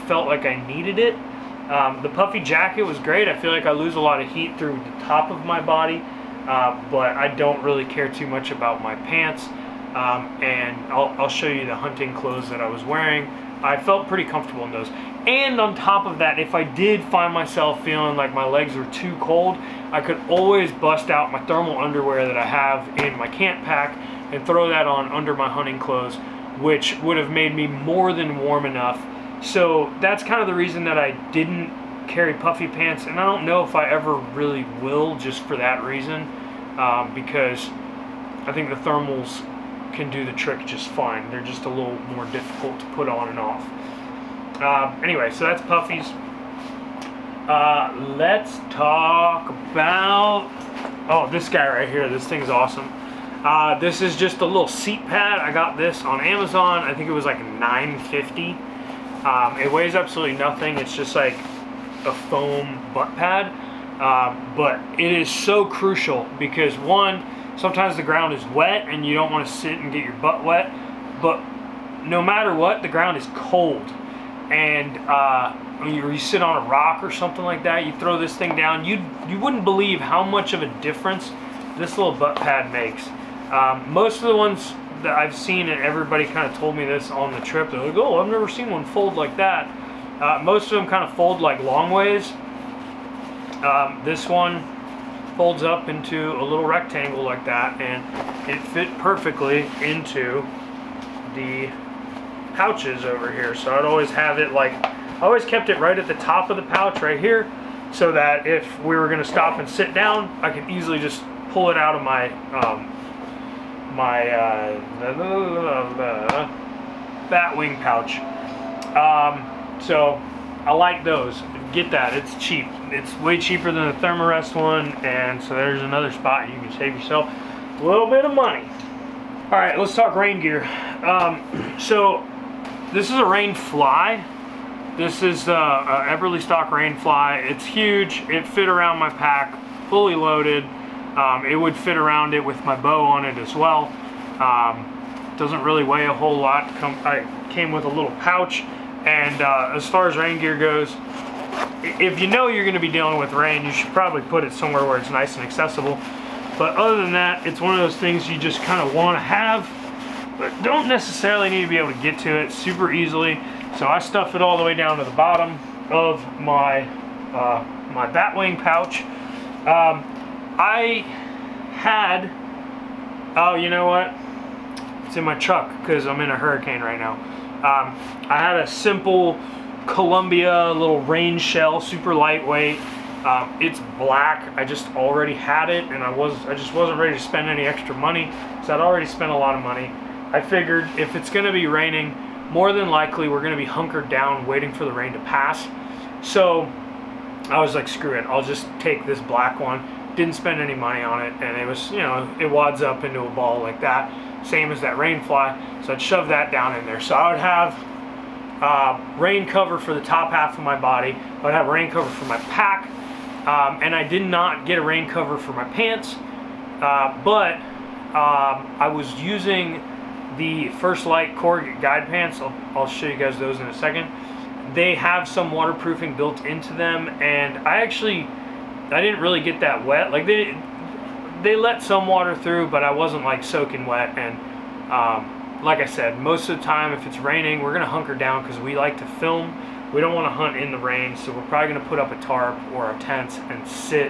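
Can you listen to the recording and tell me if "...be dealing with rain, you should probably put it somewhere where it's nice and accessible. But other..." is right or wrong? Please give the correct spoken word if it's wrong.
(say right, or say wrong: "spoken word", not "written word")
right.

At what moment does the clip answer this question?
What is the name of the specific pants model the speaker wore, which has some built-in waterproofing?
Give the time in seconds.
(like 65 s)
220 s.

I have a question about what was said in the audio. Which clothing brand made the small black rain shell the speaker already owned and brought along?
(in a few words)
Columbia.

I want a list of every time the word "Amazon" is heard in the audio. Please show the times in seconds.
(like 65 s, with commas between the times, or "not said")
56 s.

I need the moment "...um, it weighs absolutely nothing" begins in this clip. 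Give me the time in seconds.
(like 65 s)
59 s.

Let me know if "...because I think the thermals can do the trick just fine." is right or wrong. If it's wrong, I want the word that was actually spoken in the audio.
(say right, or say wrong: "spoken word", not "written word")
right.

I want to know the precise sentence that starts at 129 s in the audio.
All right, let's talk rain gear.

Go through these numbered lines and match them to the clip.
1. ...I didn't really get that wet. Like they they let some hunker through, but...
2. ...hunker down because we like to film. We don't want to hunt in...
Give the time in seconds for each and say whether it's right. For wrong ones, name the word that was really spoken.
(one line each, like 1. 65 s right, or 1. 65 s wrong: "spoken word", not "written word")
1. 228 s wrong: "water", not "hunker"
2. 237 s right.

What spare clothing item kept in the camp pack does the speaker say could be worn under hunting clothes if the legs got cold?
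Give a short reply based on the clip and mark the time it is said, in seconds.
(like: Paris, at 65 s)
Thermal underwear, at 21 s.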